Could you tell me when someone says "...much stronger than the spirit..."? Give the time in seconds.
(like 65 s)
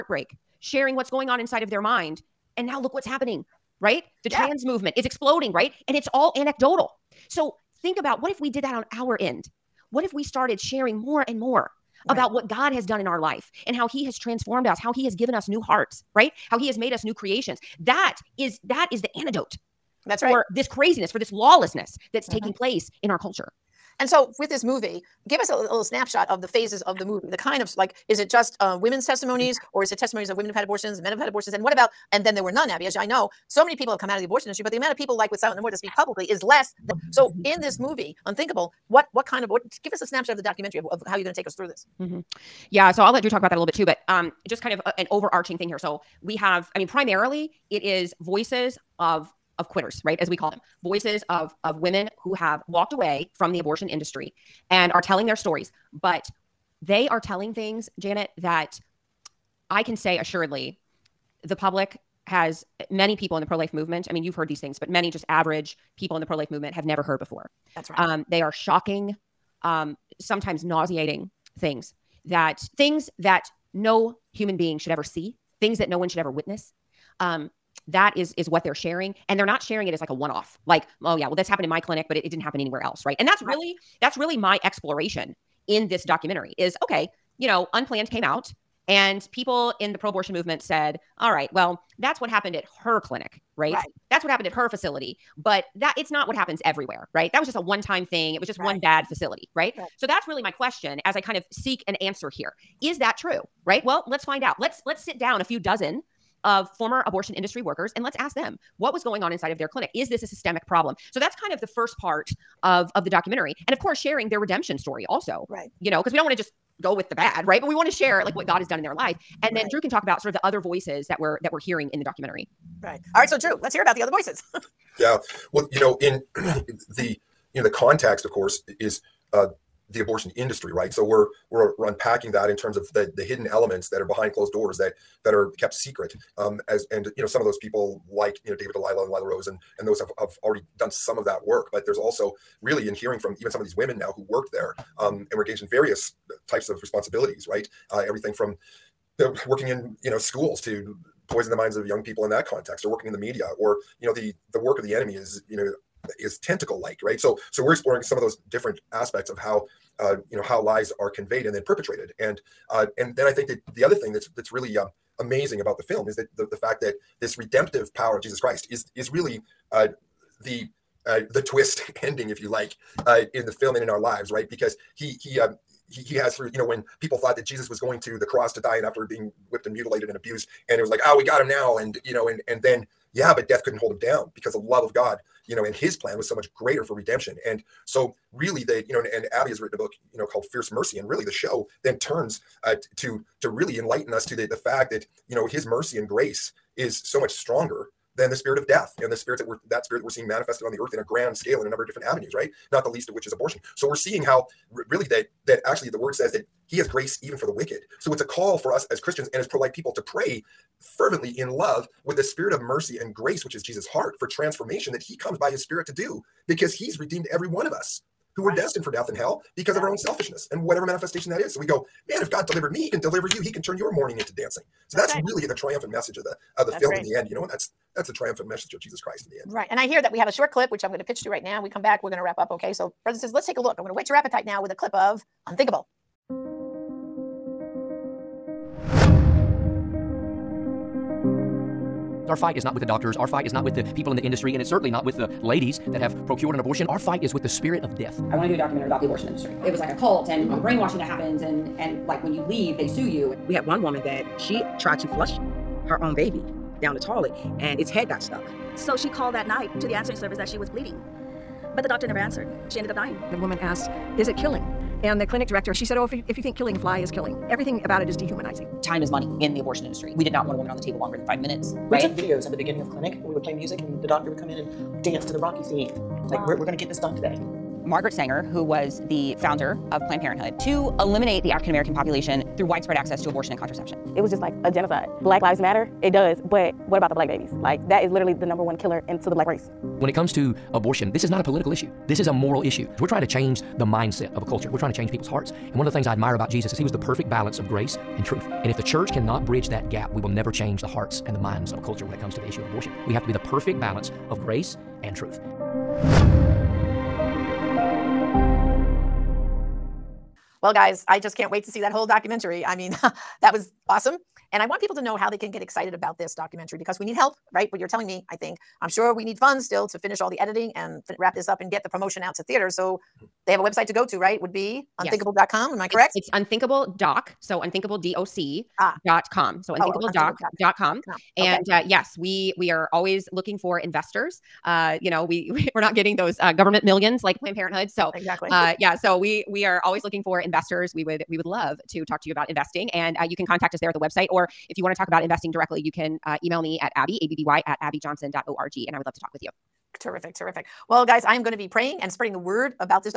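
197 s.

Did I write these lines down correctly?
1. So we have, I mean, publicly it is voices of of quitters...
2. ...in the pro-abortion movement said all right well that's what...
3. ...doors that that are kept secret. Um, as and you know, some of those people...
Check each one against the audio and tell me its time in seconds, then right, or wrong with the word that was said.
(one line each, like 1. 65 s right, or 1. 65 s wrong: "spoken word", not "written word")
1. 45 s wrong: "primarily", not "publicly"
2. 89 s right
3. 134 s right.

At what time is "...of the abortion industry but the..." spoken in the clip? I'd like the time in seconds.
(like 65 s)
34 s.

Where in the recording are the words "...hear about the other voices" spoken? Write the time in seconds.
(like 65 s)
123 s.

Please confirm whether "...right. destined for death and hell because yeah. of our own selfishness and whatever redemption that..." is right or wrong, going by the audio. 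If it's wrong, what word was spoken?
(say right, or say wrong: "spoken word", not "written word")
wrong: "manifestation", not "redemption".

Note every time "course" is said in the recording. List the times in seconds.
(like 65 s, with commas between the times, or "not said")
113 s, 128 s.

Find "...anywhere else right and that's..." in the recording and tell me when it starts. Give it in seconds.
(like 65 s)
82 s.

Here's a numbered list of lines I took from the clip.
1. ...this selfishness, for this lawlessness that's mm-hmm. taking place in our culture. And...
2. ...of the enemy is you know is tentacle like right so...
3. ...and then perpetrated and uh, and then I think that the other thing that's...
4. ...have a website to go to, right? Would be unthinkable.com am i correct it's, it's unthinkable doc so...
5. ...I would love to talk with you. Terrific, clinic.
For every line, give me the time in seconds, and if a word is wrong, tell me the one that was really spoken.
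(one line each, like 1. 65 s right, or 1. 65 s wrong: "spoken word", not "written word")
1. 20 s wrong: "craziness", not "selfishness"
2. 154 s right
3. 161 s right
4. 323 s right
5. 348 s wrong: "terrific", not "clinic".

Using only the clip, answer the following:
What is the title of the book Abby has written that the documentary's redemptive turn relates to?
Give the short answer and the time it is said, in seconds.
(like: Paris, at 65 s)
Fierce Mercy, at 190 s.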